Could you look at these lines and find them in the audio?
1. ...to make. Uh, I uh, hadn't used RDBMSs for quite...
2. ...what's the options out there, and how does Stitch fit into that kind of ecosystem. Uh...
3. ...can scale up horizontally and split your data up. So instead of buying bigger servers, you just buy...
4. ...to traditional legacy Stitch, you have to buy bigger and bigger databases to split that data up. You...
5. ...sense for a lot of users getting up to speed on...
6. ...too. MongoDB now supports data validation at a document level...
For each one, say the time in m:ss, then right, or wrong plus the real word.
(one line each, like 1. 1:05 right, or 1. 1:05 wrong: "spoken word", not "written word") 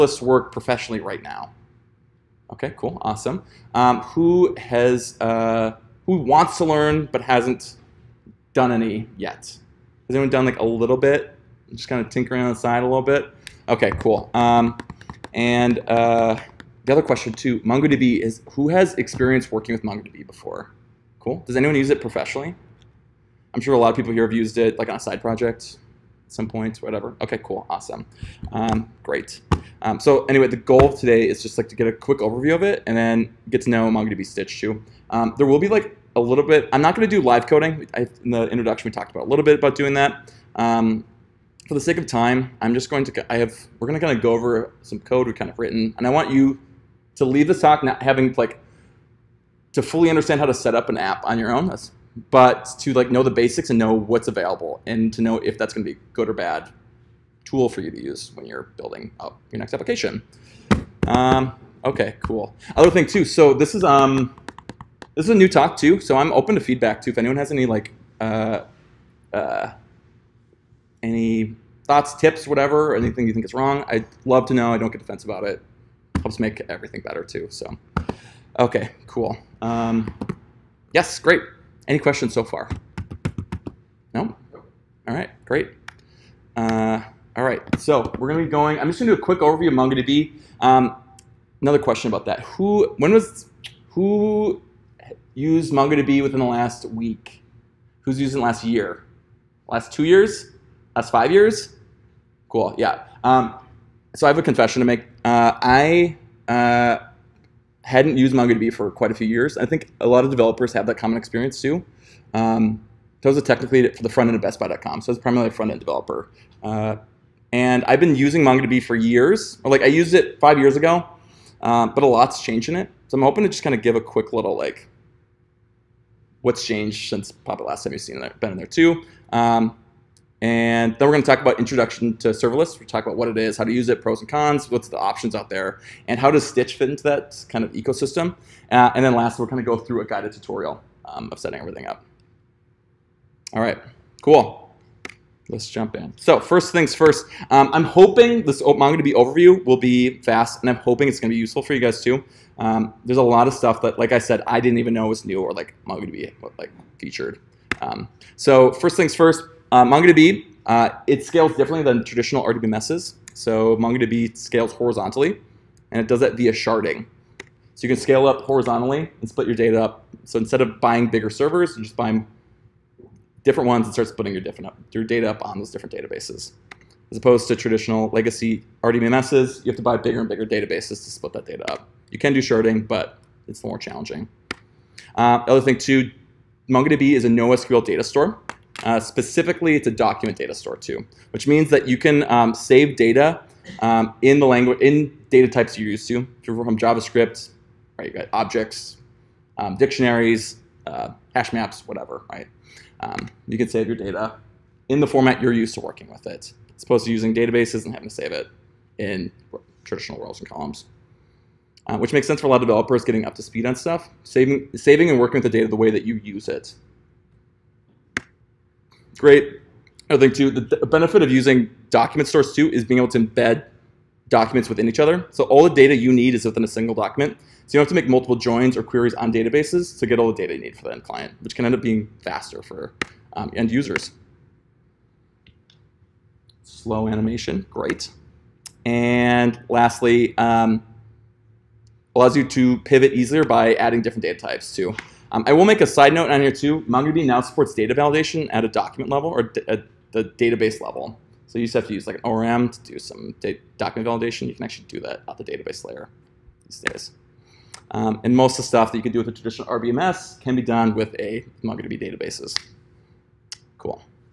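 1. 1:44 wrong: "MongoDB", not "RDBMSs"
2. 2:14 right
3. 2:47 right
4. 2:57 wrong: "RDBMSs", not "Stitch"
5. 3:32 wrong: "developers", not "users"
6. 4:06 right.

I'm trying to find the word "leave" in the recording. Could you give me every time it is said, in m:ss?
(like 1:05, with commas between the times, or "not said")
0:47.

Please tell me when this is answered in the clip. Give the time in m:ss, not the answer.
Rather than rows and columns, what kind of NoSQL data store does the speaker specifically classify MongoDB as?
3:09.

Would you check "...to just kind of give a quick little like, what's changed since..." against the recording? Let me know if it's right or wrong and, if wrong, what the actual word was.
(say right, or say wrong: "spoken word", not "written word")
right.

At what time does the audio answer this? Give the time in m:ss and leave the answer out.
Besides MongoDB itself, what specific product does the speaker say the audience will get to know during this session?
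0:33.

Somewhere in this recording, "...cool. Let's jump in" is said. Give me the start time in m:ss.
2:24.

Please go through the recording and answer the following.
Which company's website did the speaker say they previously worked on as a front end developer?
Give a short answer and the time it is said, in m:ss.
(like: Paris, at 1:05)
BestBuy.com, at 1:54.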